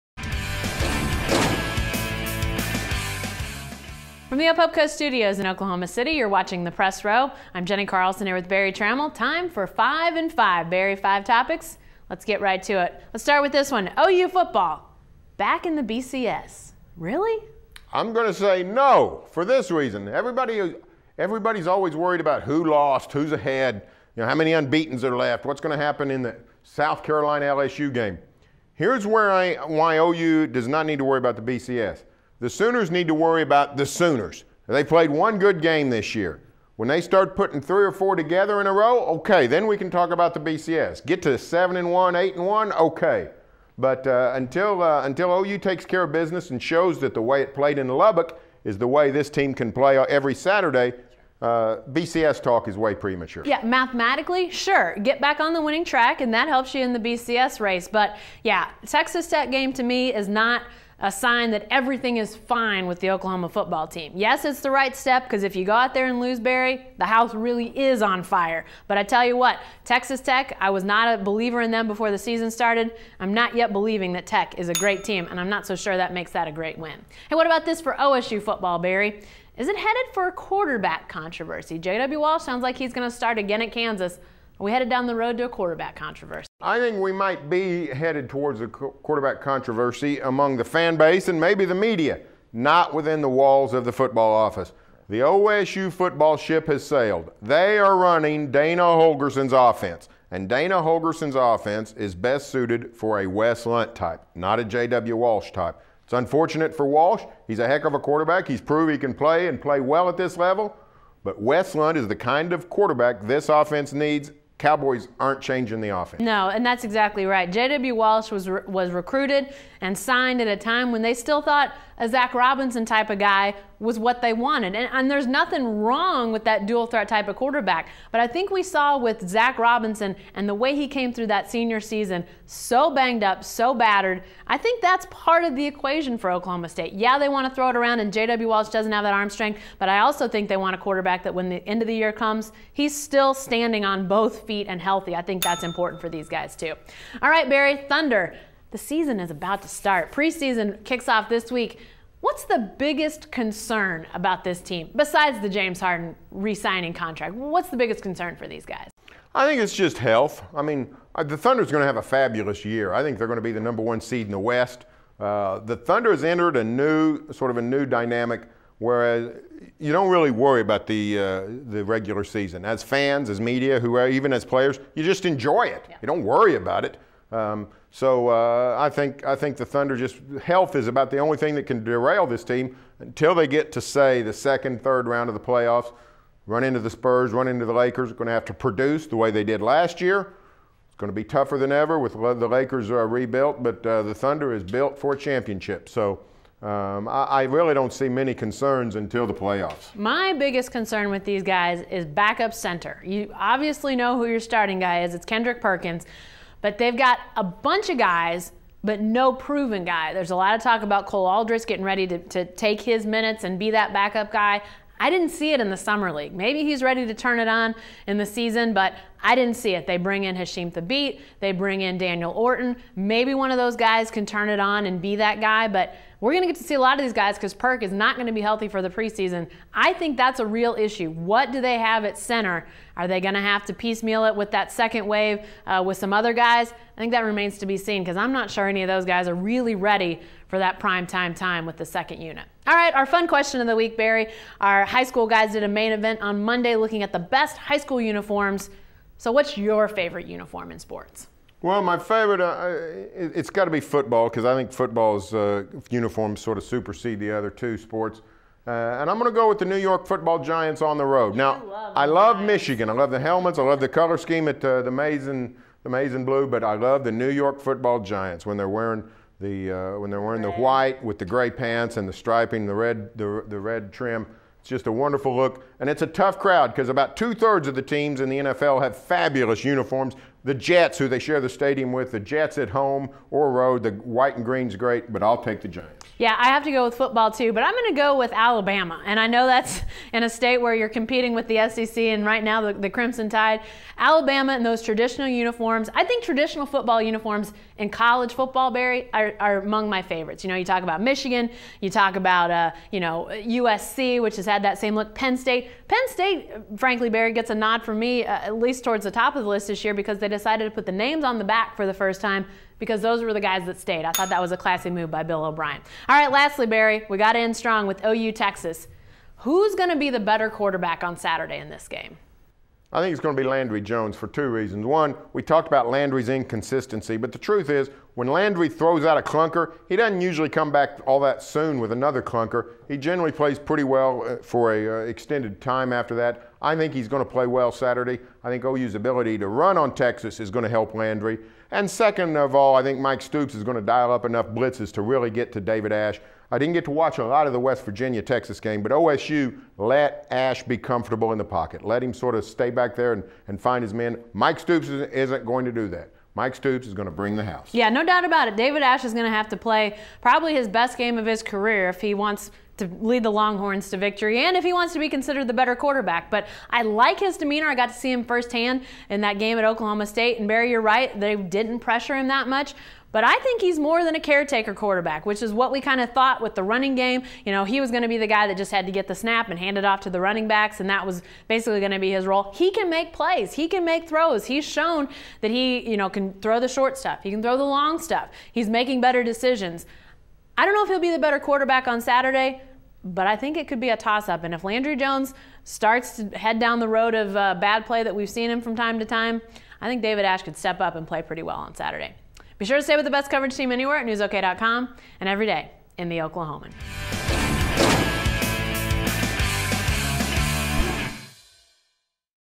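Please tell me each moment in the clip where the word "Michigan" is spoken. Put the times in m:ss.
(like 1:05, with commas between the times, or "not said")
4:22, 5:01.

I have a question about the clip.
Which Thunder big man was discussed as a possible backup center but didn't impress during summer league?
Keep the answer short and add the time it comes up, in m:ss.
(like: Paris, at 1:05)
Cole Aldrich, at 3:31.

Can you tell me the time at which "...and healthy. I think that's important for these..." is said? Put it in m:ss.
2:24.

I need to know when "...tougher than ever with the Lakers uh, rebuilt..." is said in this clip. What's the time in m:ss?
3:11.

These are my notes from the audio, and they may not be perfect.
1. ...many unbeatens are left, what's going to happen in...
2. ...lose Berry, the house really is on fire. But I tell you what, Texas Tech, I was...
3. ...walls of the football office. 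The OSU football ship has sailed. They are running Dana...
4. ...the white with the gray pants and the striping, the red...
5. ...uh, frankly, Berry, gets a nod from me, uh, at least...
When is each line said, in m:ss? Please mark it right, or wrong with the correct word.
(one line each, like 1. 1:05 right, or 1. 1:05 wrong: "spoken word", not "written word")
1. 0:24 right
2. 1:06 right
3. 1:33 right
4. 4:30 right
5. 5:06 right.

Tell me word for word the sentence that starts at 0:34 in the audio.
They played one good game this year.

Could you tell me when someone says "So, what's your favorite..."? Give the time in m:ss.
4:09.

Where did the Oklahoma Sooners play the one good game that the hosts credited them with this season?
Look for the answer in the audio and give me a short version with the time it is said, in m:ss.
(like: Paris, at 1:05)
Lubbock, at 0:47.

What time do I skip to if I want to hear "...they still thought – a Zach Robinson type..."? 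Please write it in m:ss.
2:01.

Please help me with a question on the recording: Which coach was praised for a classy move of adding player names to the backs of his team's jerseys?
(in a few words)
Bill O'Brien.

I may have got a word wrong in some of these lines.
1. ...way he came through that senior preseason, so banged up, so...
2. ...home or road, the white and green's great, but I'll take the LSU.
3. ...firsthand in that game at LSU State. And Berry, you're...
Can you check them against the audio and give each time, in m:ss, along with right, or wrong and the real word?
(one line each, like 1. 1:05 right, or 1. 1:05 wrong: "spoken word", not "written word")
1. 2:10 wrong: "season", not "preseason"
2. 4:42 wrong: "Giants", not "LSU"
3. 6:08 wrong: "Oklahoma", not "LSU".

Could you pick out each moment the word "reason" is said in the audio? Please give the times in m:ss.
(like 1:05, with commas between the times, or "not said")
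0:19, 5:24.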